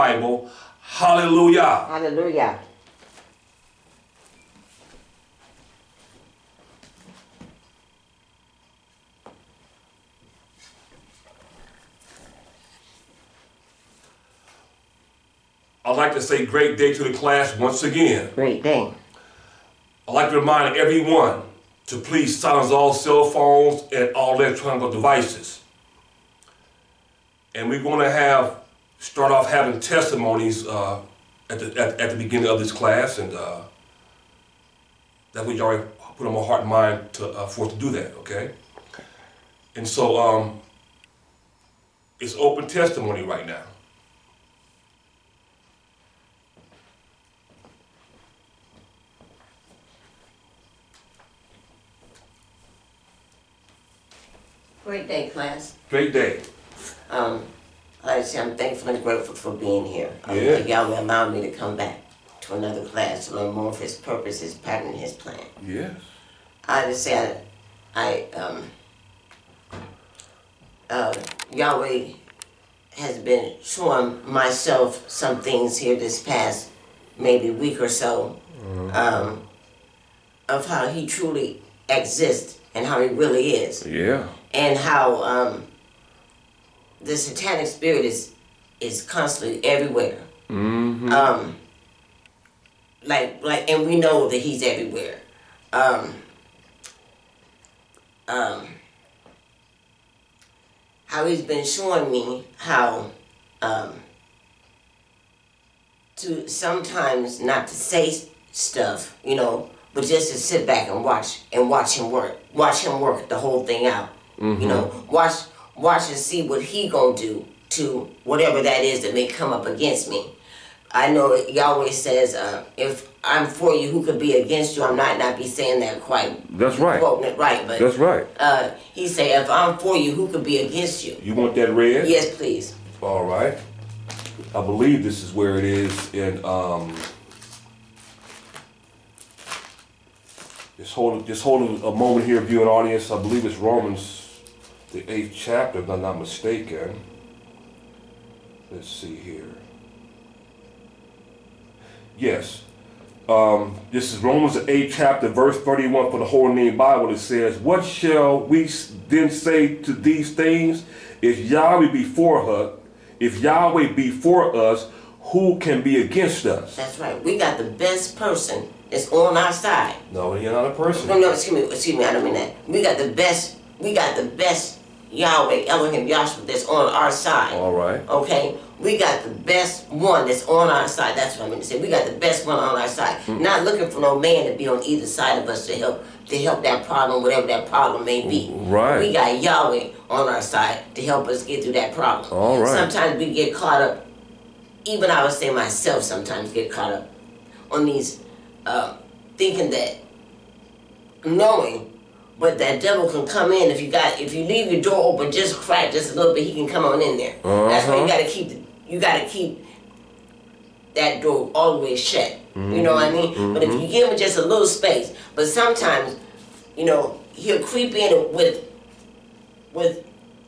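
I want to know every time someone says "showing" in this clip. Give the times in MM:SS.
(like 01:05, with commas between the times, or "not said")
01:13, 01:41.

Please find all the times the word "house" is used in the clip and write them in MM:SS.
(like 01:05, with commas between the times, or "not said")
not said.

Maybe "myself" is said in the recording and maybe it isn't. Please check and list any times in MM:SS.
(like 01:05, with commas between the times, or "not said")
01:14, 03:15.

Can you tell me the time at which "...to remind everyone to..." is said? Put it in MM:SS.
00:20.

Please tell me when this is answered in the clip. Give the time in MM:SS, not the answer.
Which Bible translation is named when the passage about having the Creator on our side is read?
02:36.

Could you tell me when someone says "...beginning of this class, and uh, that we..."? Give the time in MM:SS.
00:32.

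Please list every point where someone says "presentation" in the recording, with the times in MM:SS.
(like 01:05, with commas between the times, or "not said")
not said.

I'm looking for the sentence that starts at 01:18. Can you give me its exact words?
um, of how He truly exists and how He really is.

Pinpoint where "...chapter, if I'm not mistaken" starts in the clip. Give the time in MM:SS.
02:25.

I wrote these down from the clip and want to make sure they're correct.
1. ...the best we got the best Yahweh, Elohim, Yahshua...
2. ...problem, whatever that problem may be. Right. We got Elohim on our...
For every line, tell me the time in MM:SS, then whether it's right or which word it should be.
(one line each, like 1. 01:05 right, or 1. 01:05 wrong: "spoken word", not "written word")
1. 02:52 right
2. 03:06 wrong: "Yahweh", not "Elohim".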